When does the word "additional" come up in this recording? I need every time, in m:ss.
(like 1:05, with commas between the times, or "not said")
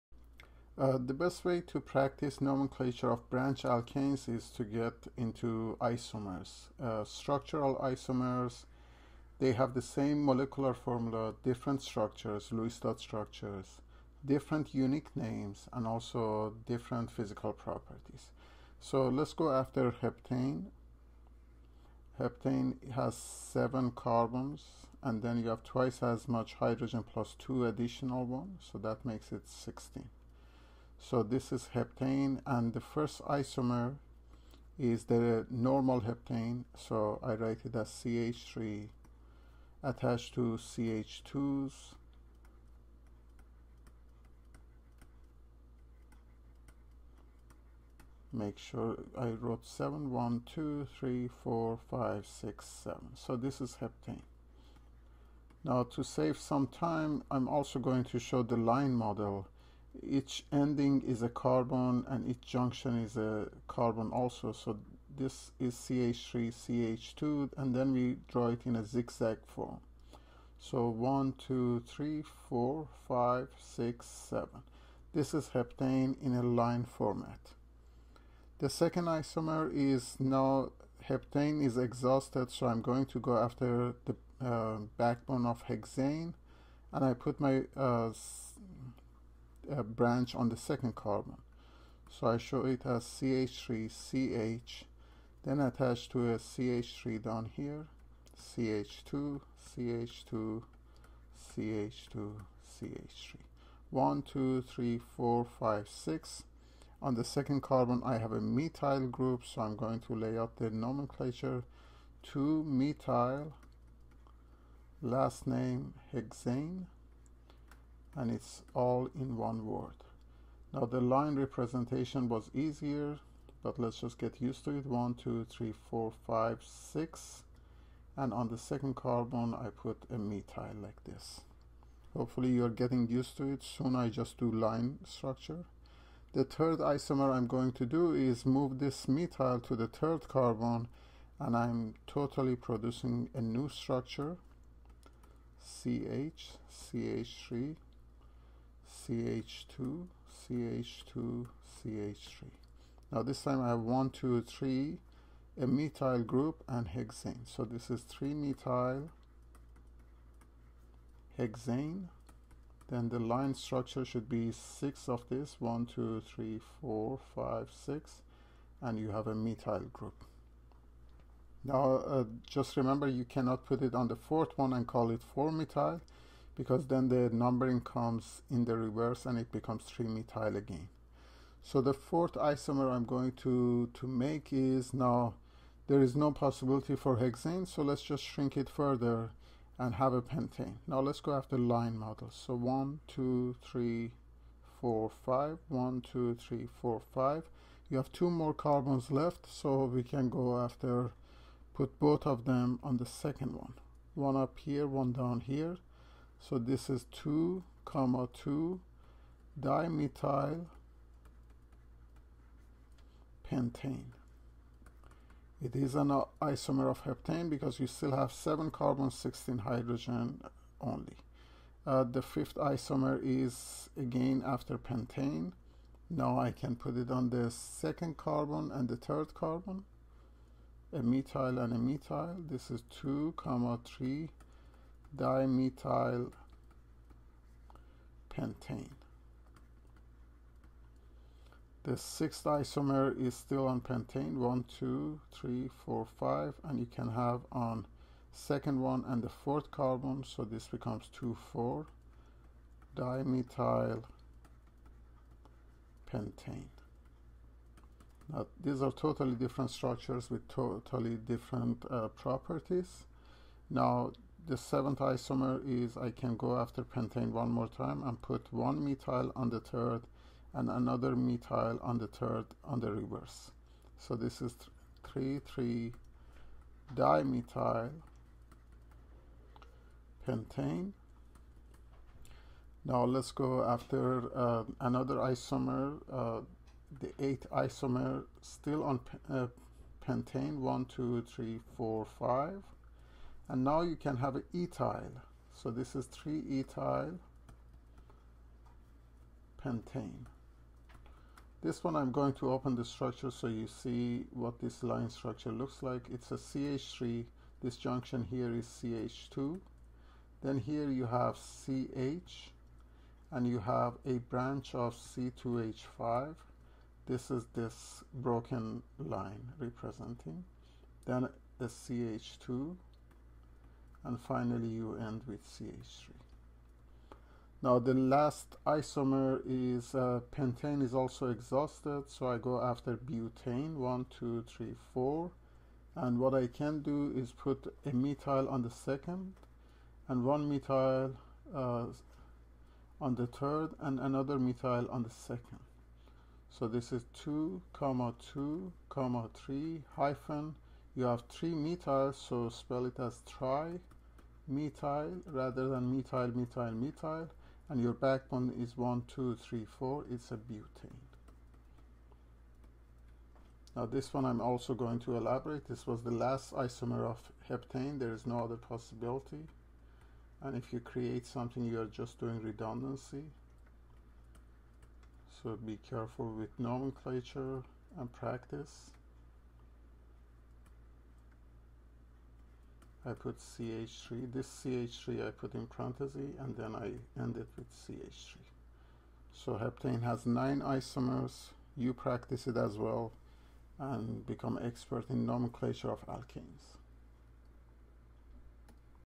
0:27.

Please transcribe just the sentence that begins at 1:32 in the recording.
So I show it as CH3, CH, then attach to a CH3 down here, CH2, CH2, CH2, CH3.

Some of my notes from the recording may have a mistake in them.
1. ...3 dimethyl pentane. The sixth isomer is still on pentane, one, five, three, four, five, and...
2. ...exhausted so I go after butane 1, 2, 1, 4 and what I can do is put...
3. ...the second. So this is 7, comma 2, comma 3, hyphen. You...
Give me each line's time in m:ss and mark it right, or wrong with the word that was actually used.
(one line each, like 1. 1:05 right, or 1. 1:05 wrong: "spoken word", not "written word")
1. 3:53 wrong: "two", not "five"
2. 5:31 wrong: "3", not "1"
3. 5:45 wrong: "2", not "7".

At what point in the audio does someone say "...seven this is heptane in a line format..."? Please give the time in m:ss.
1:14.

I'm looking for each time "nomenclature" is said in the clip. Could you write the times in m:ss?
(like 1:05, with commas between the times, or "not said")
0:02, 1:50, 6:16, 6:35.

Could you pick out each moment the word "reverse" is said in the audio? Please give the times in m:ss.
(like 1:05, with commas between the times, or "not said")
2:58, 4:32.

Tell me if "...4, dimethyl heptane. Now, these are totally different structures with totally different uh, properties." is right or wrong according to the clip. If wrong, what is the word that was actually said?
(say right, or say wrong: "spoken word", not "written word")
wrong: "pentane", not "heptane".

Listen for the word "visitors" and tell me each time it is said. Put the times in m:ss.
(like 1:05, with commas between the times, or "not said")
not said.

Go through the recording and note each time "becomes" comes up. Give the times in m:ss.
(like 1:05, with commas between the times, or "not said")
2:59, 4:10, 6:34.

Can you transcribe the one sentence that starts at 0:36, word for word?
So I write it as CH3 attached to CH2s.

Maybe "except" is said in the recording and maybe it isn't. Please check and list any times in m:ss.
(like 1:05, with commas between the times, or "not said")
not said.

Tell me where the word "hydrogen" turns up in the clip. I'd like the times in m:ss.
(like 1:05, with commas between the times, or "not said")
0:26, 3:39.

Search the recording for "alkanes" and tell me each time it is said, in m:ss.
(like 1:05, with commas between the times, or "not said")
0:03, 6:36.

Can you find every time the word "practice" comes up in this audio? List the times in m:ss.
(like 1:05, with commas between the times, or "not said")
0:01, 6:18, 6:31.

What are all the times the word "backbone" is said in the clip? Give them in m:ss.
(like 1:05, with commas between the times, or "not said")
1:24, 5:57.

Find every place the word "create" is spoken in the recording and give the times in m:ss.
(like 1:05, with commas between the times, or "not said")
6:10.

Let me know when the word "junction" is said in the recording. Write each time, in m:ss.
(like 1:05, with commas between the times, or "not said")
1:02, 5:07.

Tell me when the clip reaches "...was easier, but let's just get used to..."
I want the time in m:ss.
2:02.